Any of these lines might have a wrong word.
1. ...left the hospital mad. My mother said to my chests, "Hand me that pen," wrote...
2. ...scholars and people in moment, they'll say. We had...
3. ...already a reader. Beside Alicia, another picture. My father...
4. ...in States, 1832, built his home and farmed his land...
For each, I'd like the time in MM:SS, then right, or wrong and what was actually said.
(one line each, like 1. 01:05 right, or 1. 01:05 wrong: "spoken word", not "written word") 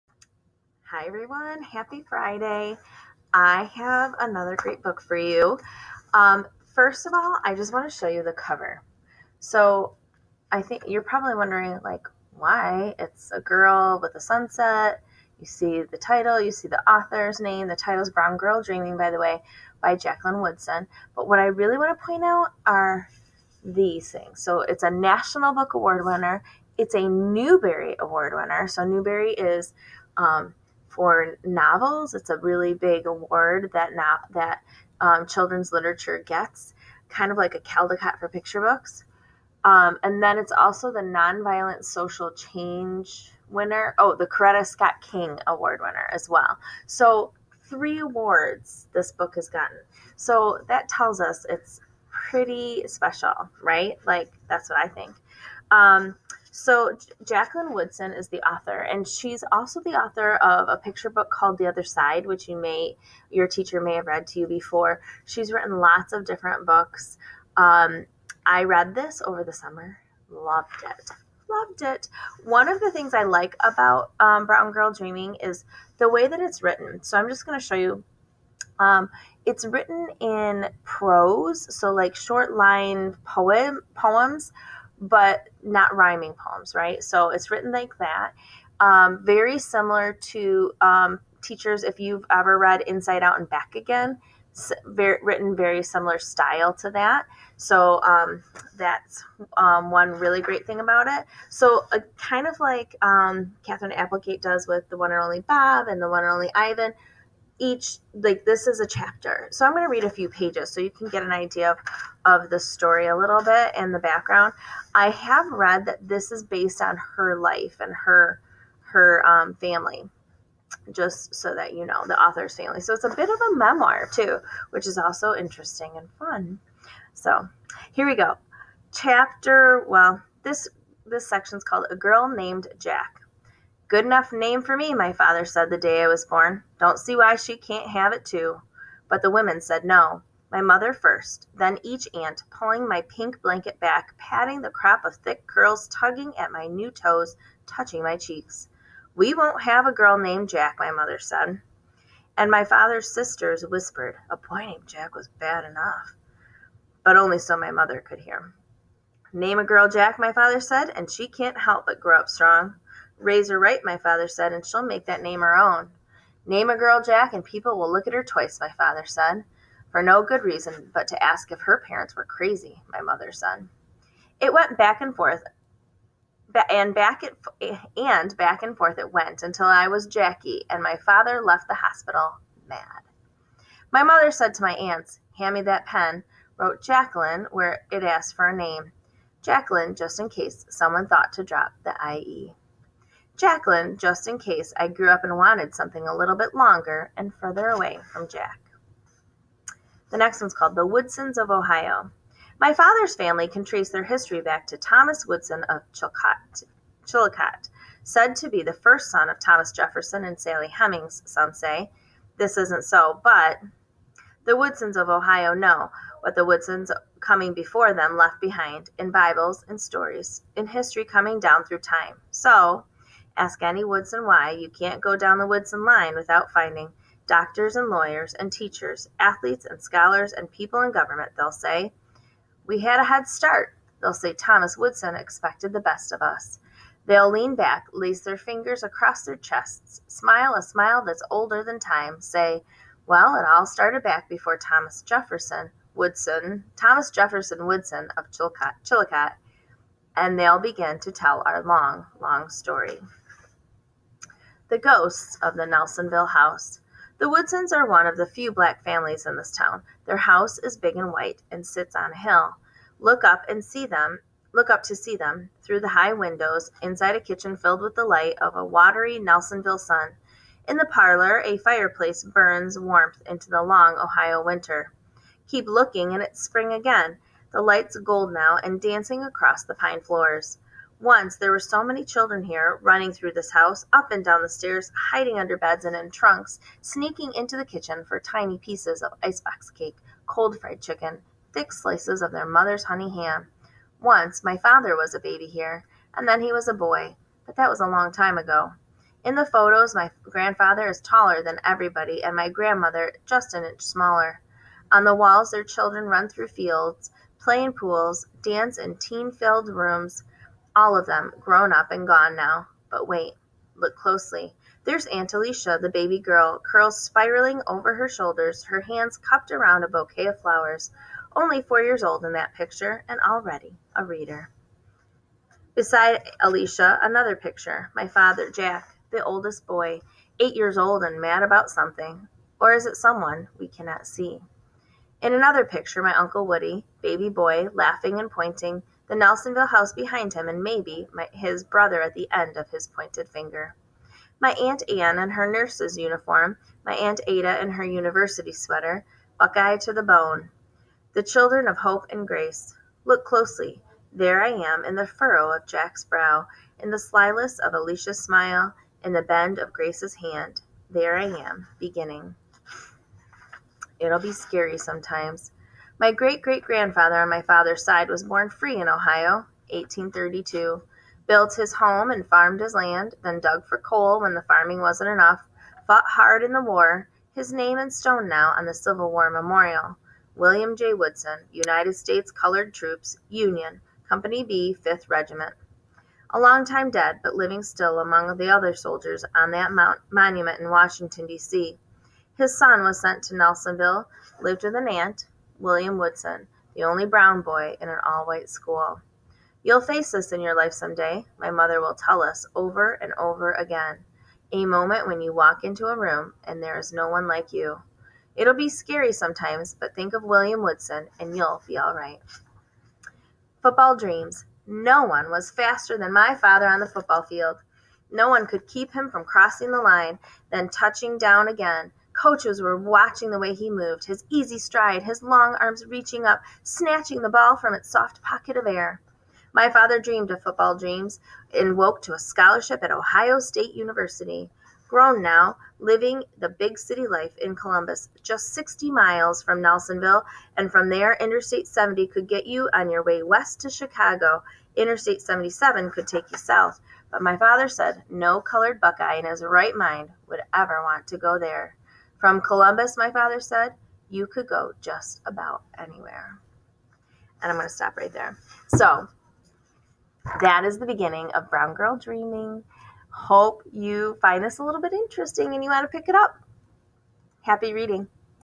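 1. 03:01 wrong: "aunts", not "chests"
2. 03:49 wrong: "government", not "moment"
3. 05:23 right
4. 06:08 wrong: "Ohio", not "States".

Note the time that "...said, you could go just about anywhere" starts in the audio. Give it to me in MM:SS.
07:33.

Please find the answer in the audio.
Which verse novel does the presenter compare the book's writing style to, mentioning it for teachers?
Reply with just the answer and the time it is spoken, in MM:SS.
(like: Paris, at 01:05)
Inside Out and Back Again, at 01:32.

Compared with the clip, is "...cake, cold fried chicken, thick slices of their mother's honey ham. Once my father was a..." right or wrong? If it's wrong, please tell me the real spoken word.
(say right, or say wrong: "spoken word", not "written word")
right.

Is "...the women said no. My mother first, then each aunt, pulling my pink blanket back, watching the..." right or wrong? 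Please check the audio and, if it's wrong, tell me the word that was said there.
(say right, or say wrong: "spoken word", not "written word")
wrong: "patting", not "watching".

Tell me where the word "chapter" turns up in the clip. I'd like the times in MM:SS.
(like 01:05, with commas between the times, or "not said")
01:48, 02:08.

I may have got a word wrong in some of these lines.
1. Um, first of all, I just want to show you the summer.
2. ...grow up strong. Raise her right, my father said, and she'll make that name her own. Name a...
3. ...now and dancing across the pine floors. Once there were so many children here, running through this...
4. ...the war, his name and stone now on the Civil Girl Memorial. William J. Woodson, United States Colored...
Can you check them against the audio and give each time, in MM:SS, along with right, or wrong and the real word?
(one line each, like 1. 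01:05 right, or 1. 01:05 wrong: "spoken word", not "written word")
1. 00:06 wrong: "cover", not "summer"
2. 02:41 right
3. 04:38 right
4. 06:16 wrong: "War", not "Girl".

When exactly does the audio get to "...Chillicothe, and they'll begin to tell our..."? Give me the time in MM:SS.
04:08.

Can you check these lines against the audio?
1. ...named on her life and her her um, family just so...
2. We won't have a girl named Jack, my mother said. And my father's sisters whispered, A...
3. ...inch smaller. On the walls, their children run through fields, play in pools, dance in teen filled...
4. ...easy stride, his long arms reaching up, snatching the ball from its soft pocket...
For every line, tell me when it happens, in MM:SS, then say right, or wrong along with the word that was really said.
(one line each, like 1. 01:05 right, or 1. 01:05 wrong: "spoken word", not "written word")
1. 01:56 wrong: "based", not "named"
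2. 02:29 right
3. 05:03 right
4. 07:04 right.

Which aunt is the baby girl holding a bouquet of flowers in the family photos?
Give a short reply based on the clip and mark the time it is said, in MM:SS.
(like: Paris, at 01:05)
Aunt Alicia, at 05:15.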